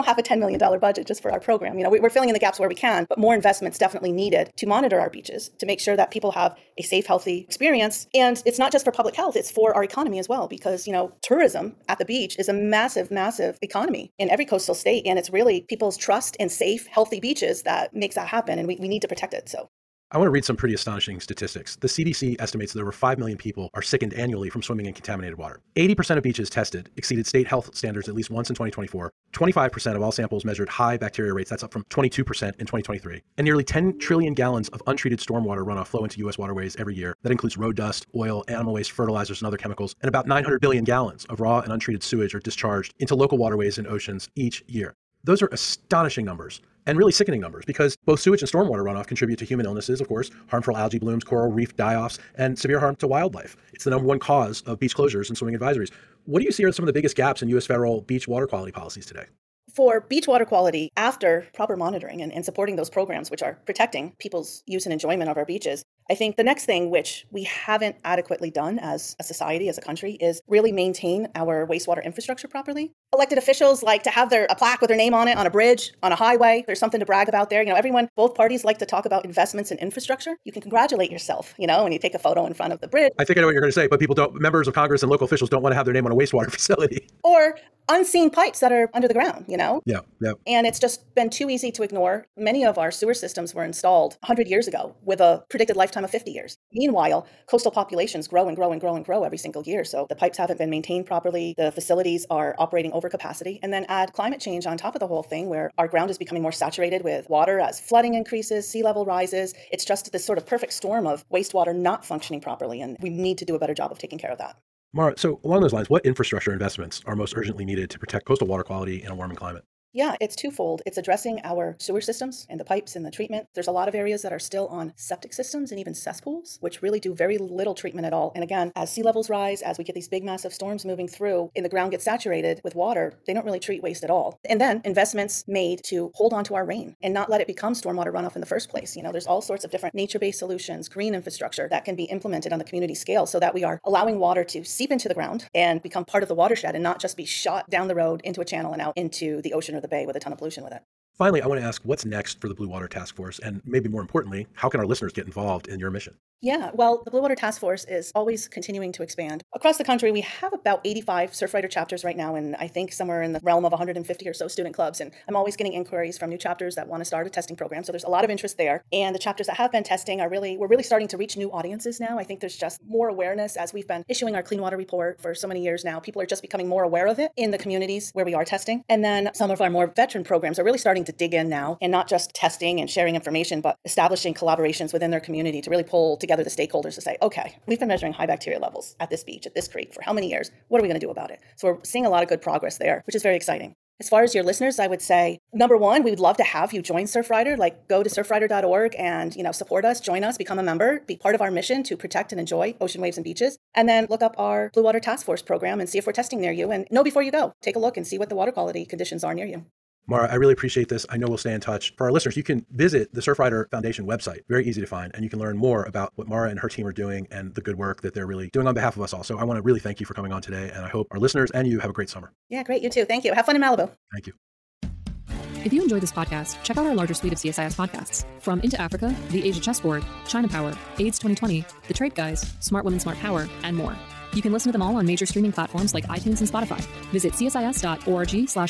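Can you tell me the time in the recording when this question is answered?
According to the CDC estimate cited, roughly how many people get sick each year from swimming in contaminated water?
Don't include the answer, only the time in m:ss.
0:22.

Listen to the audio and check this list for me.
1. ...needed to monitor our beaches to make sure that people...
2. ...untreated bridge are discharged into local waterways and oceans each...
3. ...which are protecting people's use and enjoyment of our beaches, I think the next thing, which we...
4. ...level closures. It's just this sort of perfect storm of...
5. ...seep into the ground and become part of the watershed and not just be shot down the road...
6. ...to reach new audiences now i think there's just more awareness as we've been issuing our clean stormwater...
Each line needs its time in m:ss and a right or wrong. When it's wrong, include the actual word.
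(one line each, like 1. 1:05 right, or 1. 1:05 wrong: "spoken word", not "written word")
1. 0:04 right
2. 0:41 wrong: "sewage", not "bridge"
3. 1:03 right
4. 1:48 wrong: "rises", not "closures"
5. 2:24 right
6. 2:51 wrong: "water", not "stormwater".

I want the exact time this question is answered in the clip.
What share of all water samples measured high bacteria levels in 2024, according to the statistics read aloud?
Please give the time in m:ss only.
0:29.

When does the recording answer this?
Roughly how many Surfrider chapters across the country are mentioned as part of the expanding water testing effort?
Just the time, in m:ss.
2:40.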